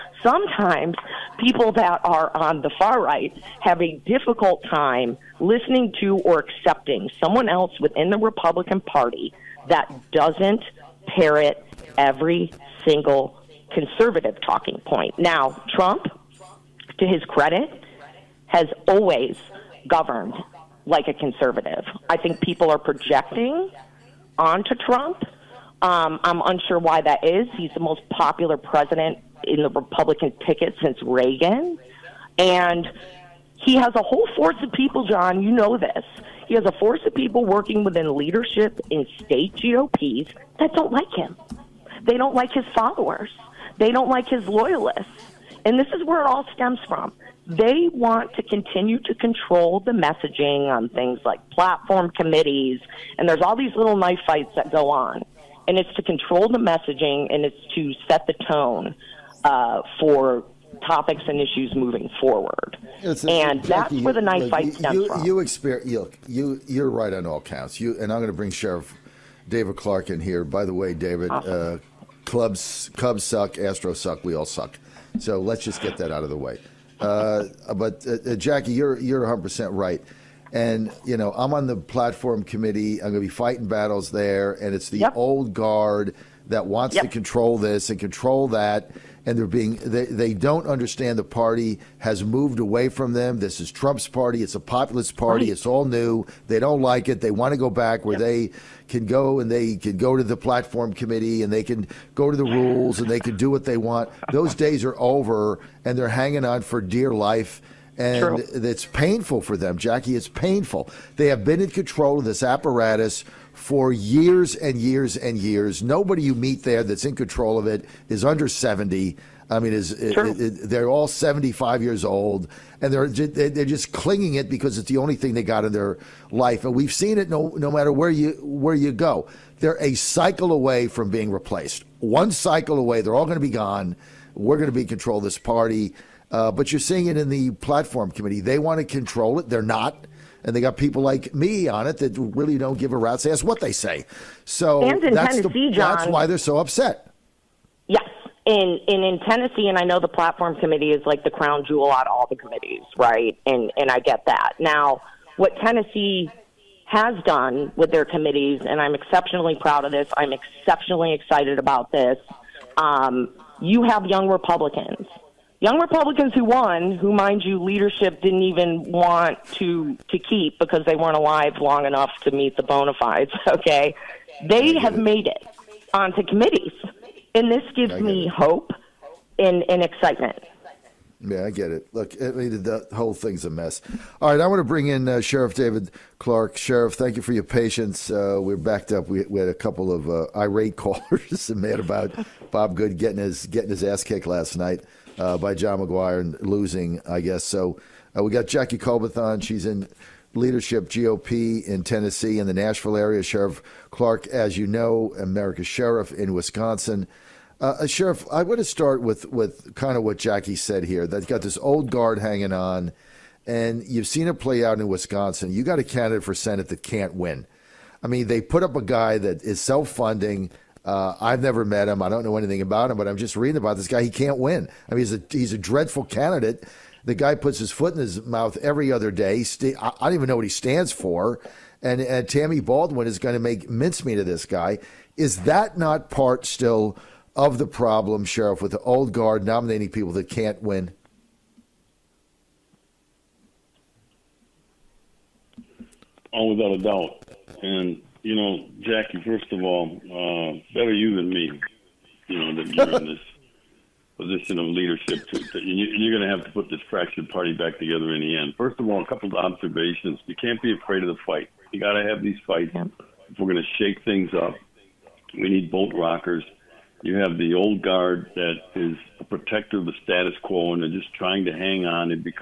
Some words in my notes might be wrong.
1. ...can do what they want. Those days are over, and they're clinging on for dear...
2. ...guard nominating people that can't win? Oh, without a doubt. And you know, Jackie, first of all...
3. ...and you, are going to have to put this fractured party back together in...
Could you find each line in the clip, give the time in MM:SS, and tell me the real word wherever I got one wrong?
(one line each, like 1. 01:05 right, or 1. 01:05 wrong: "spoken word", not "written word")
1. 01:43 wrong: "hanging", not "clinging"
2. 03:59 right
3. 04:15 right.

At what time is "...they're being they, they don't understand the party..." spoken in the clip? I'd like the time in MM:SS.
01:29.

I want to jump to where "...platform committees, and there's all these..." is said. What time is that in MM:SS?
00:51.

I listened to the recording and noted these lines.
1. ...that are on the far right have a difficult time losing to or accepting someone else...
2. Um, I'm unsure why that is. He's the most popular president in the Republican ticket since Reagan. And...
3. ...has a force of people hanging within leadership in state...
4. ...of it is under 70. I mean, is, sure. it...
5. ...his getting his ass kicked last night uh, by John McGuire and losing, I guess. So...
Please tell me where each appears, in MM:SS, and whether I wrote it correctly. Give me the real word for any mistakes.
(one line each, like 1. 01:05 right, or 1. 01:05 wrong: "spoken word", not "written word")
1. 00:01 wrong: "listening", not "losing"
2. 00:25 right
3. 00:36 wrong: "working", not "hanging"
4. 01:57 right
5. 03:13 right.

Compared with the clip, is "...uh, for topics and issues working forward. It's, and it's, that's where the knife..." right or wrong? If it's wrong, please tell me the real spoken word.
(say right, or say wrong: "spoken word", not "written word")
wrong: "moving", not "working".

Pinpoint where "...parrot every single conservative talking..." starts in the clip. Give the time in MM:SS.
00:11.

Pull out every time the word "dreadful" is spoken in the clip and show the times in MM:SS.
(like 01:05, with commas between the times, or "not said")
03:45.